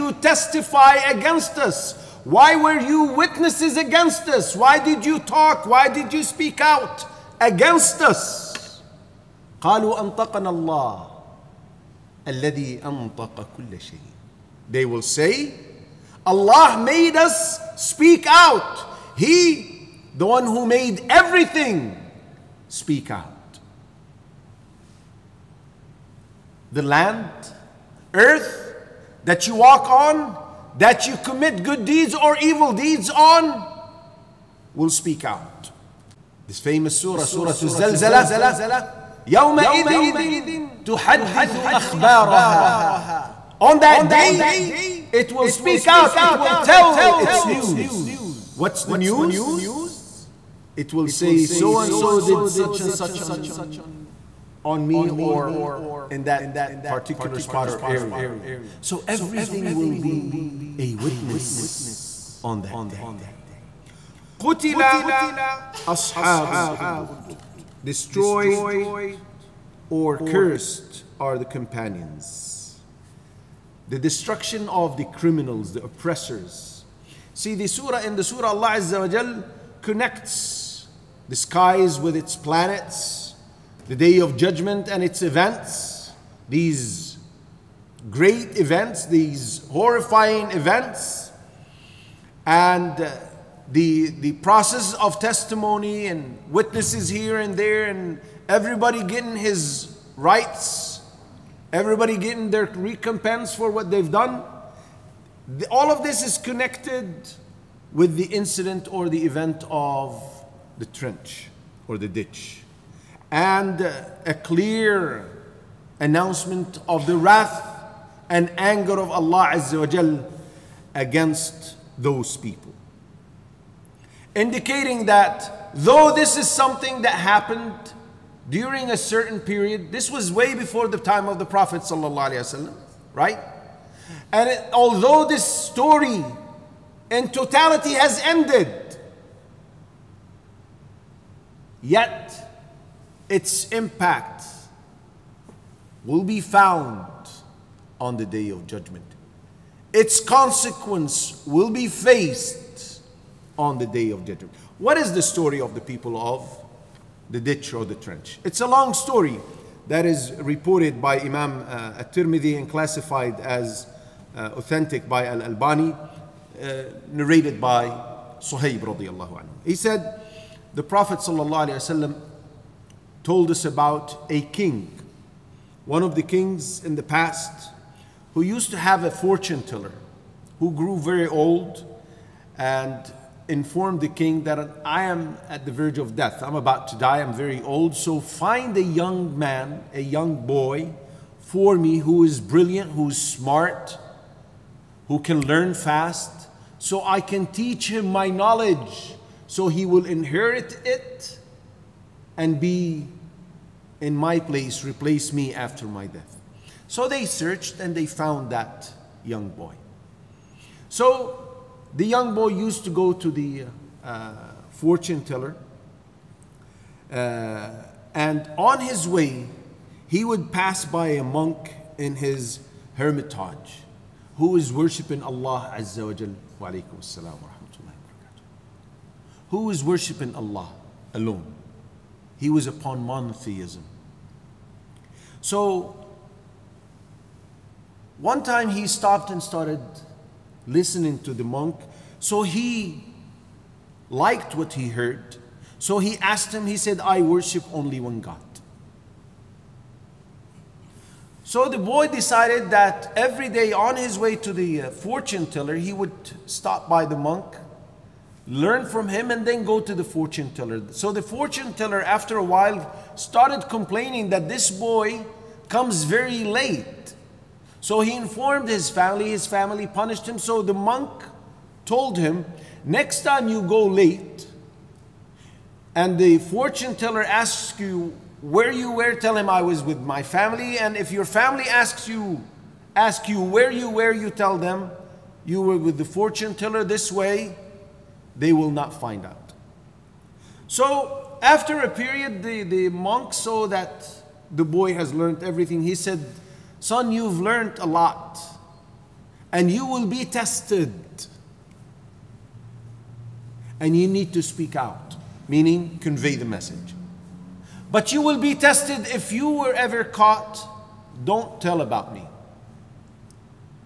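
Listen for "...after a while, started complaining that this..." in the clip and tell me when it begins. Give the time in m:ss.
4:22.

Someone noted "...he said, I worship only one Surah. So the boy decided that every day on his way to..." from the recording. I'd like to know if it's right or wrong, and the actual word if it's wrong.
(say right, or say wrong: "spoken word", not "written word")
wrong: "God", not "Surah".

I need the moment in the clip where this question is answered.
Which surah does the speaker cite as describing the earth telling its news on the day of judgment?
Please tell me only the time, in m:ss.
0:37.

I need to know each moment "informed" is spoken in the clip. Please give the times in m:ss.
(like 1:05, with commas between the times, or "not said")
3:03, 4:28.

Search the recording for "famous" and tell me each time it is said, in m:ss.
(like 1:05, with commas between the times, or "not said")
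0:36.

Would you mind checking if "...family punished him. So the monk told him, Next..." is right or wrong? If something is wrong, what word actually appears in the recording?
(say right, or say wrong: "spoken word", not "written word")
right.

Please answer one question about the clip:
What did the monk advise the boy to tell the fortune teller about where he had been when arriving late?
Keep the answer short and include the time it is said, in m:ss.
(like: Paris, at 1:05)
With my family, at 4:39.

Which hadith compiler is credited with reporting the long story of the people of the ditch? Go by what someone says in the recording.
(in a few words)
at-Tirmidhi.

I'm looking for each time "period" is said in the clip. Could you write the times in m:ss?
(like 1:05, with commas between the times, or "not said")
2:09, 4:51.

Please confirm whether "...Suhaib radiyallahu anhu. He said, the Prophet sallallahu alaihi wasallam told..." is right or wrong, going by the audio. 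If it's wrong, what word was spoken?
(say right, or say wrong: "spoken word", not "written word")
right.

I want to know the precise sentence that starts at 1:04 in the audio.
قتل أصحاب الأخدود destroyed or cursed are the companions.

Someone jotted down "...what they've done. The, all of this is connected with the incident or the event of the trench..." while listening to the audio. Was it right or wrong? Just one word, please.
right.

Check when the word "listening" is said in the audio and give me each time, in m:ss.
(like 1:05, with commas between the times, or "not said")
4:00.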